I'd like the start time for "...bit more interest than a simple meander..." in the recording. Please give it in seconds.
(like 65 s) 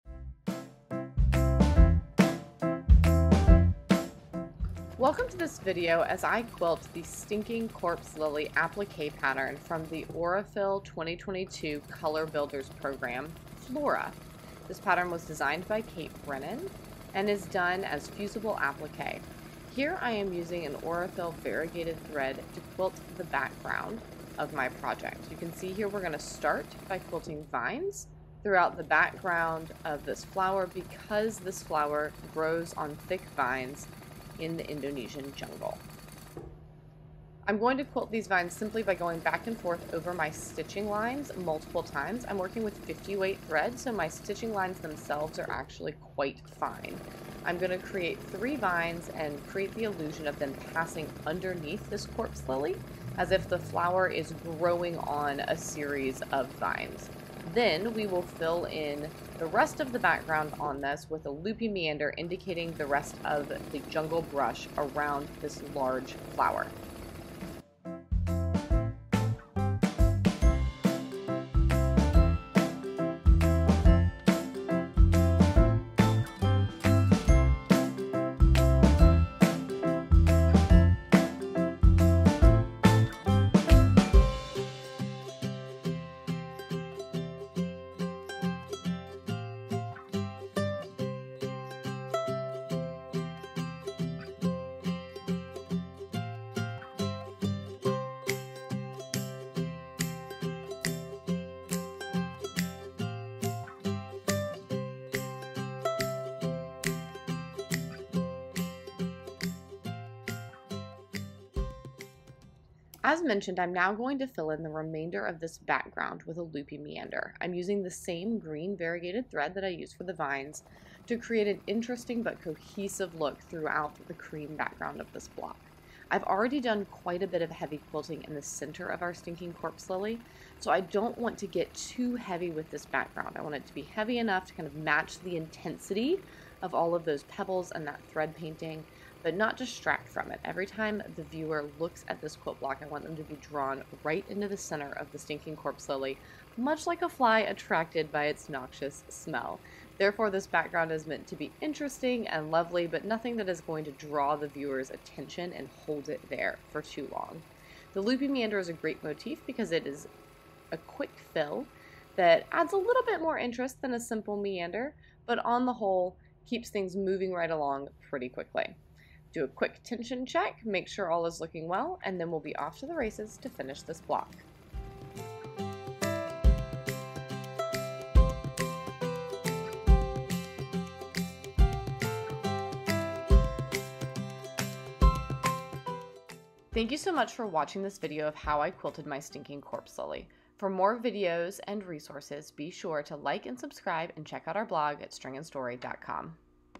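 163 s.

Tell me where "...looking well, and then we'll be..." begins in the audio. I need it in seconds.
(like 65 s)
171 s.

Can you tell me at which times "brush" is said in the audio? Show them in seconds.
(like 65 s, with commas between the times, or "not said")
64 s.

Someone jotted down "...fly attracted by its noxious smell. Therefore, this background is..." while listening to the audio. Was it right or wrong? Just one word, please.
right.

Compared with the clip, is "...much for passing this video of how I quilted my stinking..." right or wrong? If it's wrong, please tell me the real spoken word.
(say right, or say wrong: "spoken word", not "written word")
wrong: "watching", not "passing".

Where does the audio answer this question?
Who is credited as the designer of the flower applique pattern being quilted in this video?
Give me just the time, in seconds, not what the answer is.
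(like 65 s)
15 s.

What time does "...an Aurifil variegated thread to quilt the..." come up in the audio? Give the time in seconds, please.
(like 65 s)
20 s.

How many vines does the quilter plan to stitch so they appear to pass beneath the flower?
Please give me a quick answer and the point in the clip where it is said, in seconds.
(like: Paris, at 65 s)
3, at 48 s.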